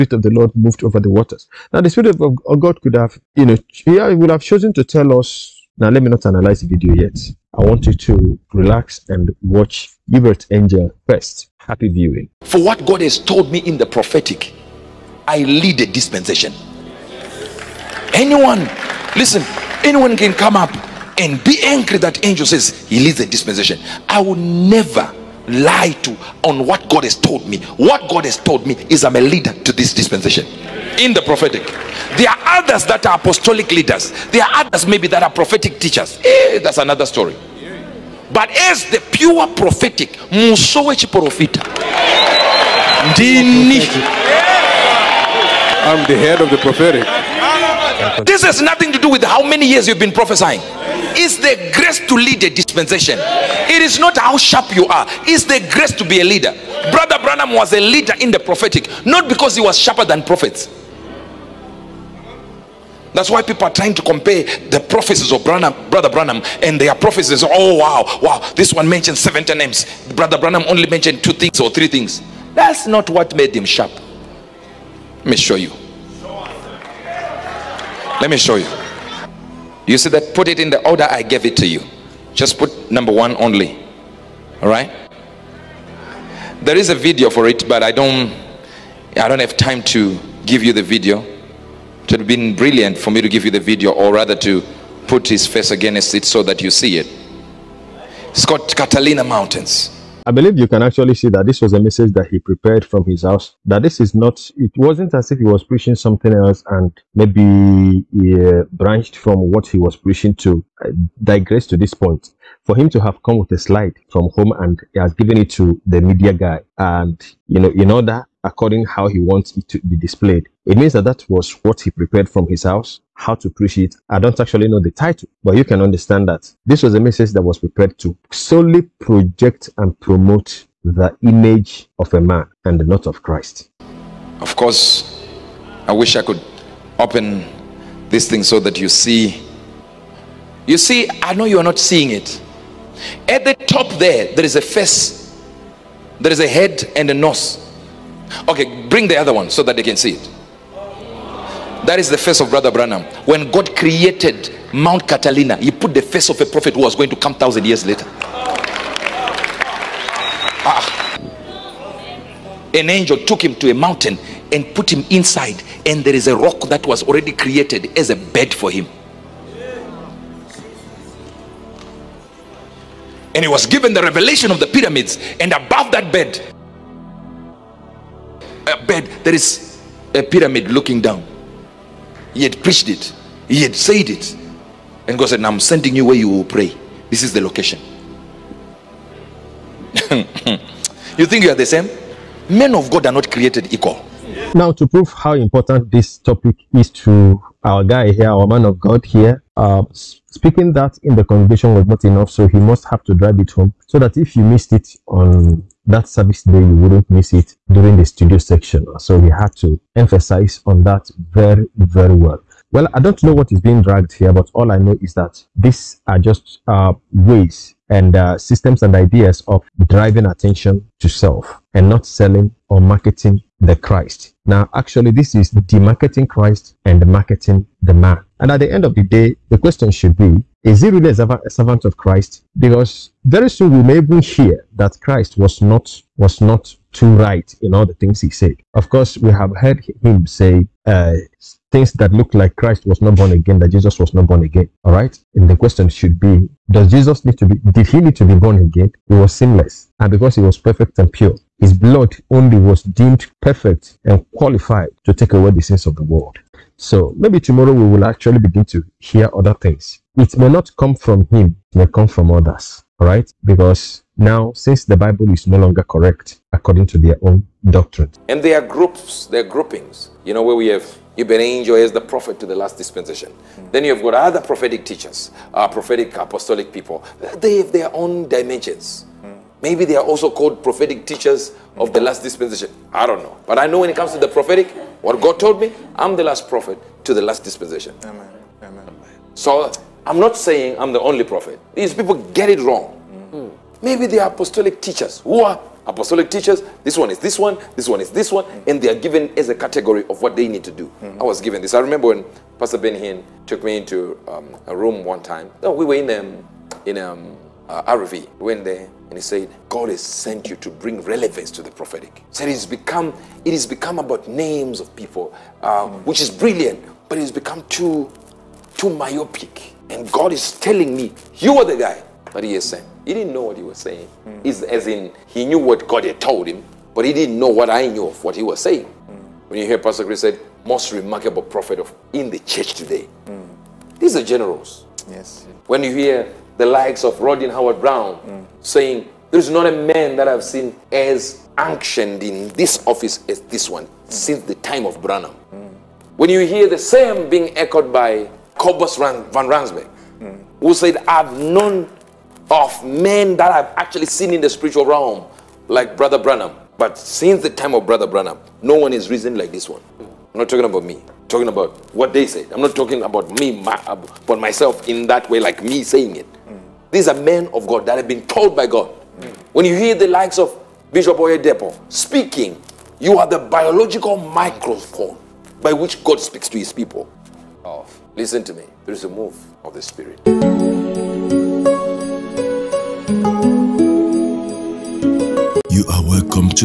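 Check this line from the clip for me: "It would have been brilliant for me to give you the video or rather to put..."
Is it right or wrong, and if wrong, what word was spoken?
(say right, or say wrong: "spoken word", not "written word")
right.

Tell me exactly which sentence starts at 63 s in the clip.
That's why people are trying to compare the prophecies of Branham, Brother Branham and their prophecies.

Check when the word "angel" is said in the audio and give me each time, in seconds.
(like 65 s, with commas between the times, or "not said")
10 s, 22 s, 162 s, 271 s.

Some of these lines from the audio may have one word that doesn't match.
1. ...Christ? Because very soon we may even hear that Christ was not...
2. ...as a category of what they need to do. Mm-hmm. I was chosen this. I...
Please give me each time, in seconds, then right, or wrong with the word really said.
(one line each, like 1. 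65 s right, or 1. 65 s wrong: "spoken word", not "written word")
1. 231 s right
2. 299 s wrong: "given", not "chosen".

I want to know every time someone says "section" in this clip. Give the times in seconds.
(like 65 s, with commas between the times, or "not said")
208 s.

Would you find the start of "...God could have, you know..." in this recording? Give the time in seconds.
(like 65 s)
2 s.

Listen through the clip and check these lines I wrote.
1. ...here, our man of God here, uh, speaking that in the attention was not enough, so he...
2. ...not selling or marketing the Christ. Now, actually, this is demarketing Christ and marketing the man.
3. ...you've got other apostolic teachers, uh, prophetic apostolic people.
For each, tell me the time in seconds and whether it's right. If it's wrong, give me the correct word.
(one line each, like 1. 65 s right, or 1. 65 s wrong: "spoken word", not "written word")
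1. 198 s wrong: "congregation", not "attention"
2. 221 s right
3. 273 s wrong: "prophetic", not "apostolic".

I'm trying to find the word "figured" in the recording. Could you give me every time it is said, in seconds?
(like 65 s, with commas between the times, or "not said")
not said.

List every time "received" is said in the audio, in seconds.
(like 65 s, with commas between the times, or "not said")
not said.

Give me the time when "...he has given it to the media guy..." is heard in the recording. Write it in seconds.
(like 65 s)
114 s.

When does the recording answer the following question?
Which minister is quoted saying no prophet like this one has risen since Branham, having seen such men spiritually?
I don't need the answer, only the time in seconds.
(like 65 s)
348 s.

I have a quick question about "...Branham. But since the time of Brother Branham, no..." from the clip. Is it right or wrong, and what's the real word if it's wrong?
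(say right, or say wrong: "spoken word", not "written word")
right.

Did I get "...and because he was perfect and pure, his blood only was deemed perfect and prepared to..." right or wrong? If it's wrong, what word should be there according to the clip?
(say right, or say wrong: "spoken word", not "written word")
wrong: "qualified", not "prepared".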